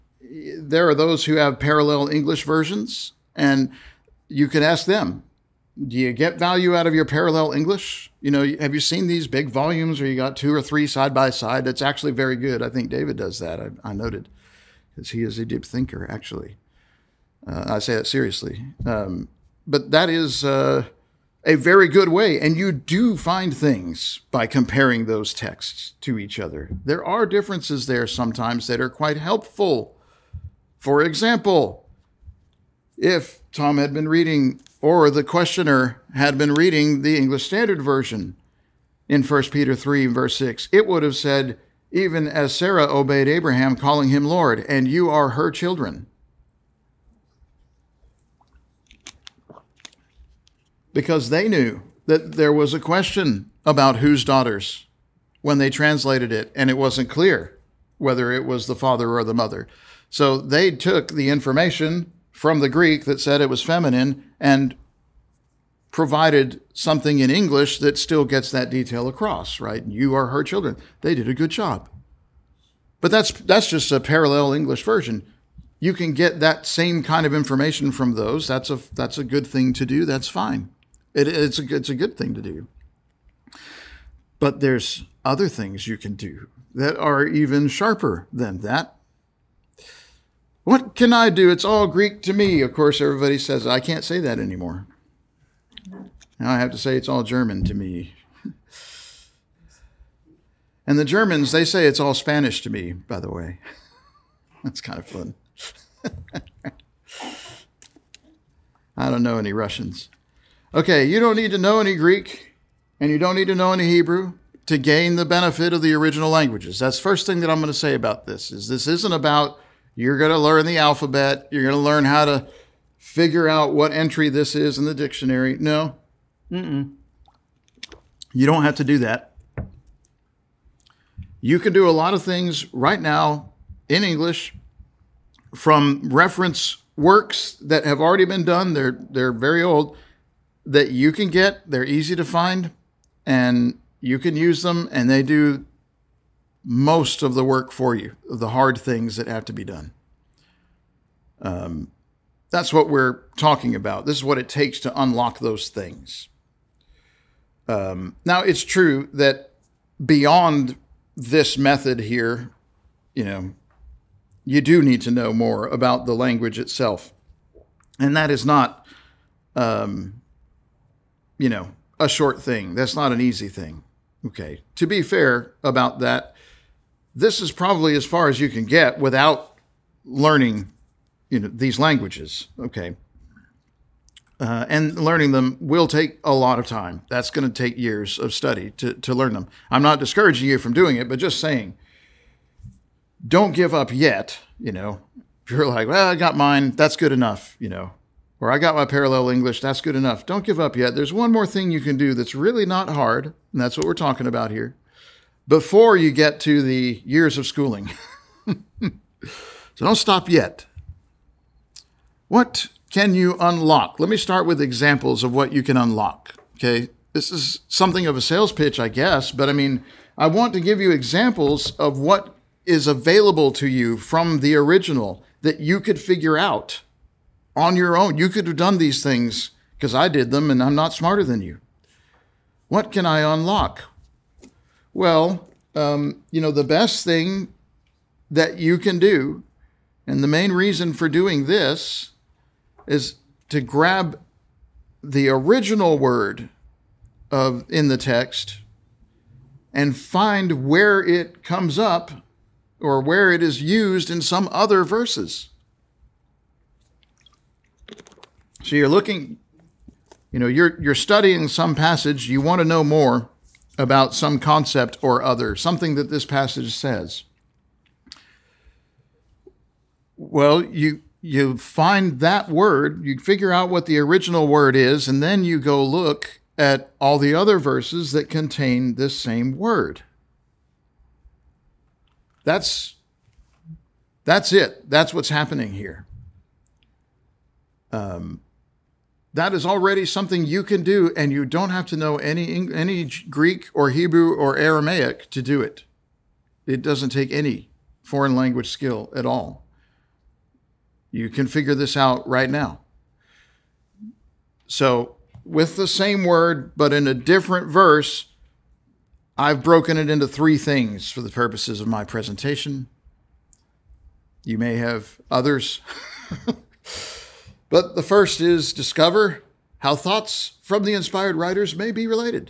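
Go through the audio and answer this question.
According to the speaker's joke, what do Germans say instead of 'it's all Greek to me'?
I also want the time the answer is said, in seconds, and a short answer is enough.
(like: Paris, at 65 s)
It's all Spanish to me, at 101 s.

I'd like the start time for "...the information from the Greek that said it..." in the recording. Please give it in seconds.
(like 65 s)
61 s.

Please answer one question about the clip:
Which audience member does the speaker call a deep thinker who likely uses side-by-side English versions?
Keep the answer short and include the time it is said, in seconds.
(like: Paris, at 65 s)
David, at 12 s.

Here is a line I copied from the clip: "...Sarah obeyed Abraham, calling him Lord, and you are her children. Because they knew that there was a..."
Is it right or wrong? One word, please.
right.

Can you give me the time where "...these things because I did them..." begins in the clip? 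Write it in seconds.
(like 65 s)
228 s.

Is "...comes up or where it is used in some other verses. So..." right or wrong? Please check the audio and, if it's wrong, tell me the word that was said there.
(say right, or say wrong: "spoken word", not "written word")
right.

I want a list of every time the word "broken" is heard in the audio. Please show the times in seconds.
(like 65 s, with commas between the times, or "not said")
309 s.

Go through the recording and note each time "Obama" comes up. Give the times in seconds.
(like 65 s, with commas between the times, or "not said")
not said.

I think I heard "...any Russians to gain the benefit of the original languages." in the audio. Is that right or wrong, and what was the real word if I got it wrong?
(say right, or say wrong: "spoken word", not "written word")
wrong: "Hebrew", not "Russians".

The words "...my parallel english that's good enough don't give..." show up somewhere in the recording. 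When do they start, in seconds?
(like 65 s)
198 s.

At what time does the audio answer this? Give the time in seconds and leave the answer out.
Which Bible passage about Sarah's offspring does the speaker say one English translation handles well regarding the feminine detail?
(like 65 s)
39 s.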